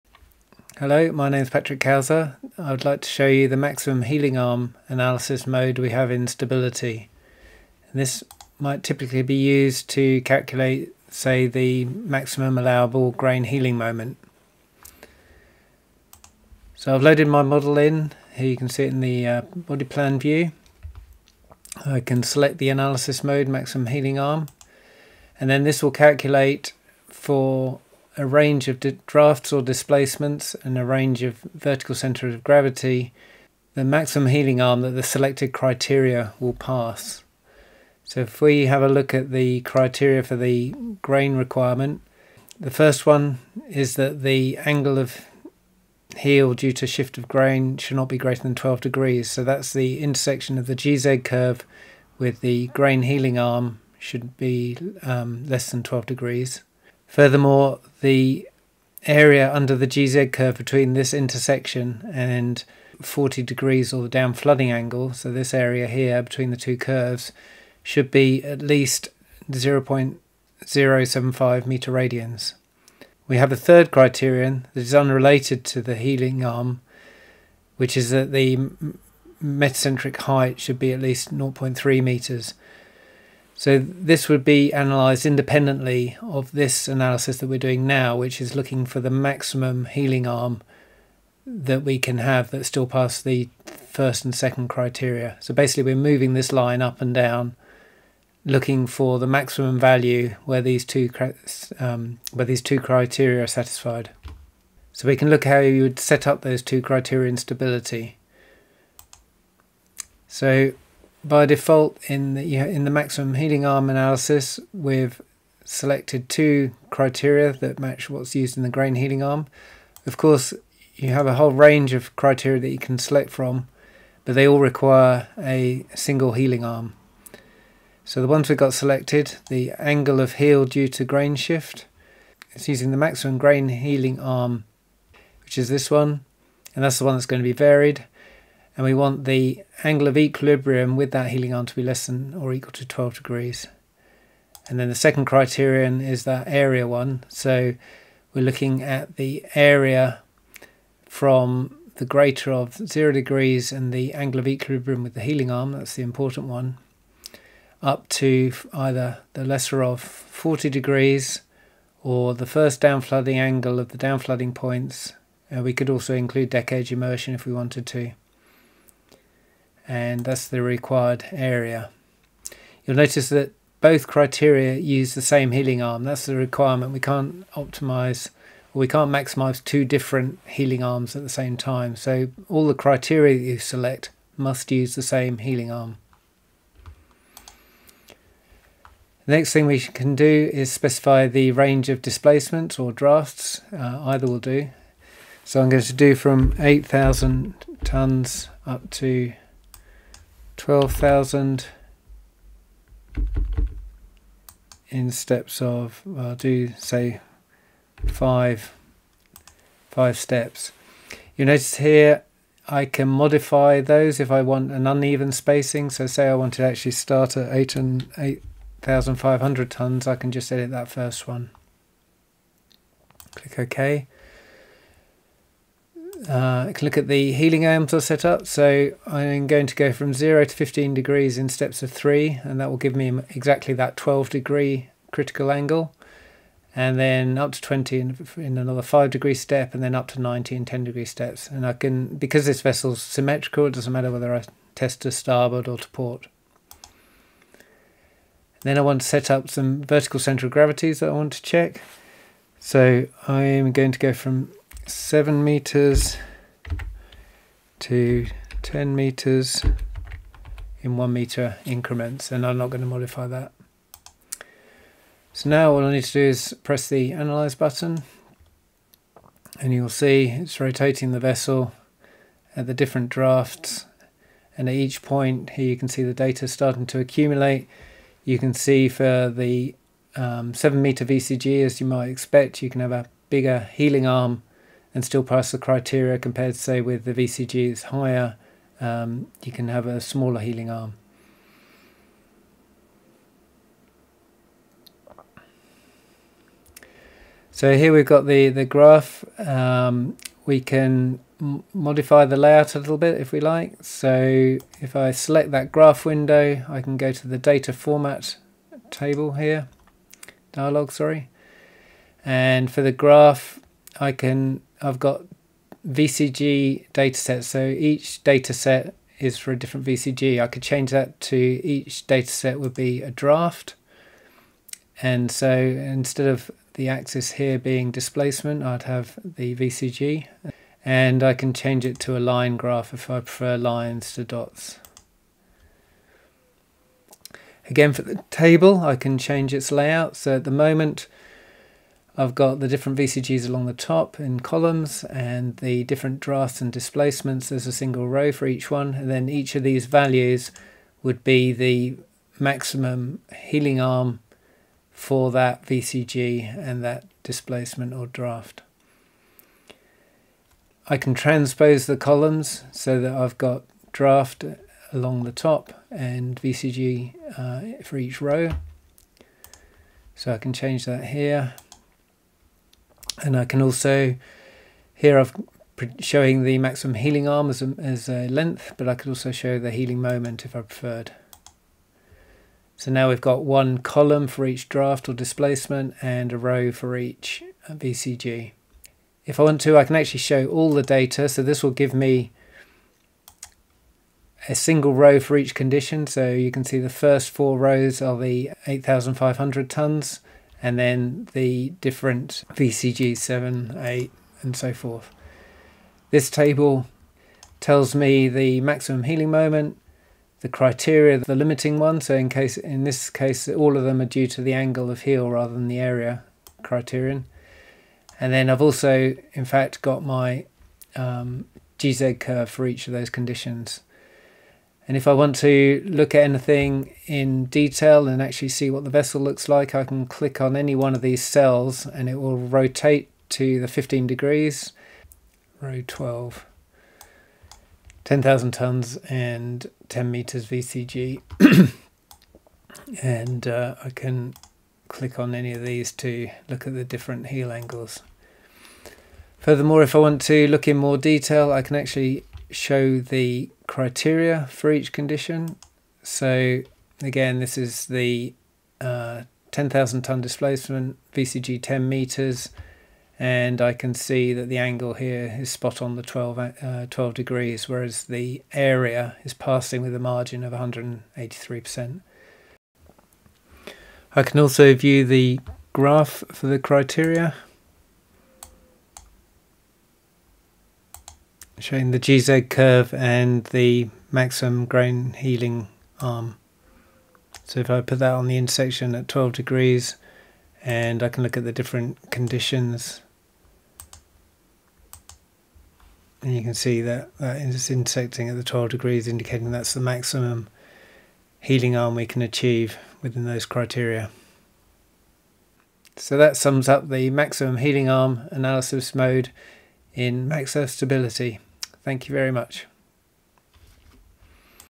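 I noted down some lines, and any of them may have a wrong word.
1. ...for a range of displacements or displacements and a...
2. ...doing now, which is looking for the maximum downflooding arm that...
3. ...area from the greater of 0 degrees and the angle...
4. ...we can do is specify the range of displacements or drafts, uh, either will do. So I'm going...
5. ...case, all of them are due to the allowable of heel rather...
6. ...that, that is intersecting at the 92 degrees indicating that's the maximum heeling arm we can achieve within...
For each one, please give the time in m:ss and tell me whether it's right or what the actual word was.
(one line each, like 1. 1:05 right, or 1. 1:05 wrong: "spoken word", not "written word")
1. 0:27 wrong: "drafts", not "displacements"
2. 1:27 wrong: "heeling", not "downflooding"
3. 2:29 right
4. 3:09 right
5. 6:53 wrong: "angle", not "allowable"
6. 8:16 wrong: "12", not "92".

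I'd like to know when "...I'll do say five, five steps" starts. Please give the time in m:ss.
3:26.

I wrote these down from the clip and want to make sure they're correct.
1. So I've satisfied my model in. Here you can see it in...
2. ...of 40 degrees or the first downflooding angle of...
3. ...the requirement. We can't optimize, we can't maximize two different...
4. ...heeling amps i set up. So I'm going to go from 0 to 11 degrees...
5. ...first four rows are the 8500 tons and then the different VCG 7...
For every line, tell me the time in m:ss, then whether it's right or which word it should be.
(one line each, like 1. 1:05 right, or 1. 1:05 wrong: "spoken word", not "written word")
1. 0:16 wrong: "loaded", not "satisfied"
2. 2:39 right
3. 2:56 right
4. 3:47 wrong: "15", not "11"
5. 6:36 right.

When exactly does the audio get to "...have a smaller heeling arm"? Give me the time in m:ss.
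4:49.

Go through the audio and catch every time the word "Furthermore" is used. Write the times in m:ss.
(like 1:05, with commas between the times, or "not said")
0:57, 7:29.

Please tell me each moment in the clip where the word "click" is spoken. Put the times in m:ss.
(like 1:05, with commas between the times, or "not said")
3:43, 7:10, 7:24.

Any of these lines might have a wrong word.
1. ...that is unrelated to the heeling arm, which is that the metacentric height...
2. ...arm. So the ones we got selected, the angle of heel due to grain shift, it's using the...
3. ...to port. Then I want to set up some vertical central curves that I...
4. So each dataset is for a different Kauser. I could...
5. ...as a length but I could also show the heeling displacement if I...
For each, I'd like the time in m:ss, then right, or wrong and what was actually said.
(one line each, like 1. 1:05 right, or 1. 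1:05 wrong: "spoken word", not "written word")
1. 1:14 right
2. 2:06 right
3. 4:05 wrong: "gravities", not "curves"
4. 5:17 wrong: "VCG", not "Kauser"
5. 6:17 wrong: "moment", not "displacement".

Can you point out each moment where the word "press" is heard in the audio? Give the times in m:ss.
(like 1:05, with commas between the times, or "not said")
4:26.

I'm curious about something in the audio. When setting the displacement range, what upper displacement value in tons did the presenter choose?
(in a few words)
12,000.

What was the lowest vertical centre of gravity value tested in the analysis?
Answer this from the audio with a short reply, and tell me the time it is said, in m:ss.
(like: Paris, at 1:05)
7 meters, at 4:14.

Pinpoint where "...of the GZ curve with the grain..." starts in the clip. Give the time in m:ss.
0:50.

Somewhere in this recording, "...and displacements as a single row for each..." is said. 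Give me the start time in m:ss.
5:46.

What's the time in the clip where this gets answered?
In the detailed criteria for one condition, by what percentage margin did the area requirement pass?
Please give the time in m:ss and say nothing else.
7:50.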